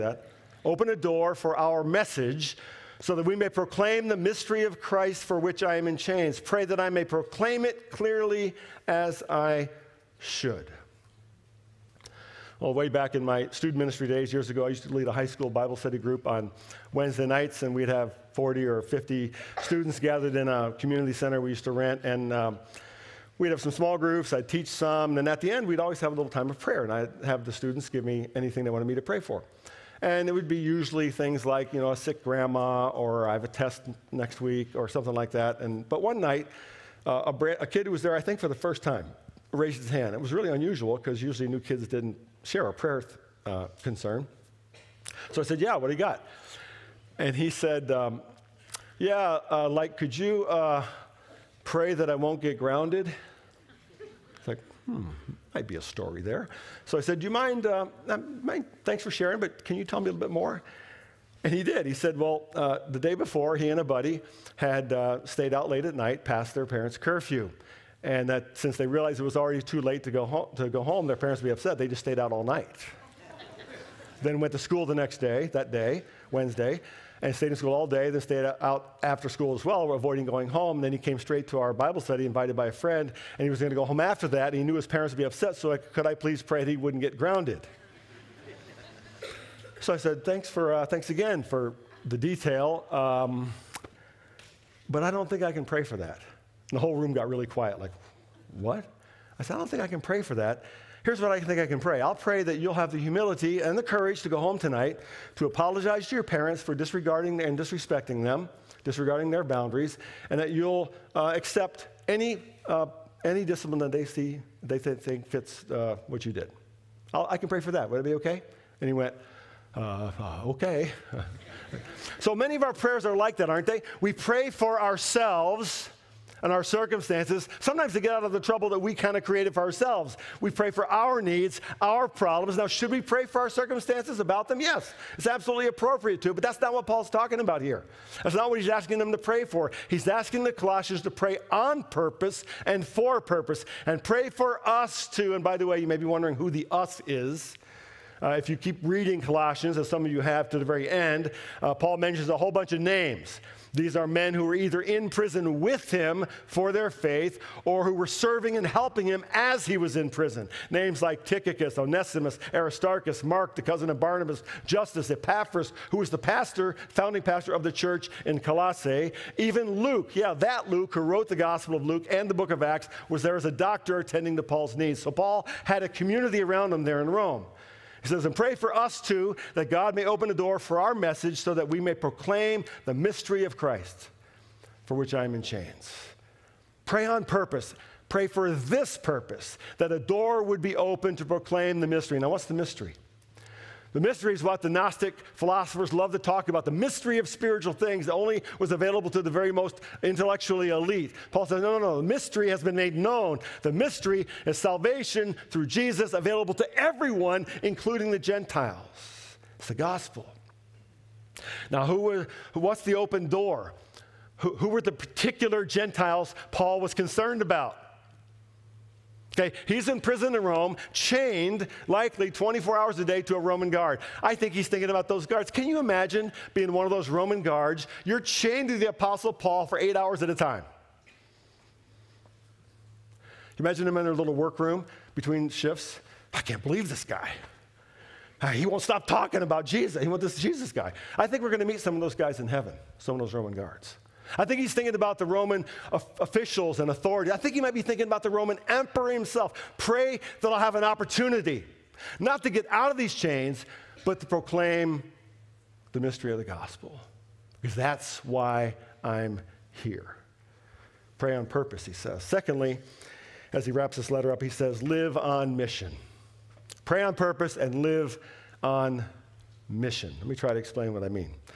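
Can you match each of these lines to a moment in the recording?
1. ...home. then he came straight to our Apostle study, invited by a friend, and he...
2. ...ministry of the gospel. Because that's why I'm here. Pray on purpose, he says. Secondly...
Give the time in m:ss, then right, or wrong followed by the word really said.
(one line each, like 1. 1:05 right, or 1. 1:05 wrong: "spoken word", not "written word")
1. 1:20 wrong: "Bible", not "Apostle"
2. 4:15 wrong: "mystery", not "ministry".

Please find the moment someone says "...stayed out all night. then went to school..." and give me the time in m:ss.
1:12.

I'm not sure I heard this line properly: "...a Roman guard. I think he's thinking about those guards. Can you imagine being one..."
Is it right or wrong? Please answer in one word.
right.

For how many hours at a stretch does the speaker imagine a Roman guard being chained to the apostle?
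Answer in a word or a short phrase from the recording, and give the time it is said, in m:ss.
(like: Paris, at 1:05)
8 hours, at 3:49.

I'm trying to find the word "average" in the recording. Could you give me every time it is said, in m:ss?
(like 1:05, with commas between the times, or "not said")
not said.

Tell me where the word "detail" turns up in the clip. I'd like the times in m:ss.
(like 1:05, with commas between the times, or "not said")
1:32.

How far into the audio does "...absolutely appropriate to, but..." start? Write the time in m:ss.
2:15.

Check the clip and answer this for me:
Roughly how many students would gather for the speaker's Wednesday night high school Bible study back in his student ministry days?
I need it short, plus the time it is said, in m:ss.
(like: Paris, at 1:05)
40 or 50, at 0:18.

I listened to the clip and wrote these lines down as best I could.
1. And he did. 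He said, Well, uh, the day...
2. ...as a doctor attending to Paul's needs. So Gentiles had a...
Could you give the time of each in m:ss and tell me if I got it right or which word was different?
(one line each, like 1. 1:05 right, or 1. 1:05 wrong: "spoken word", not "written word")
1. 1:01 right
2. 2:53 wrong: "Paul", not "Gentiles".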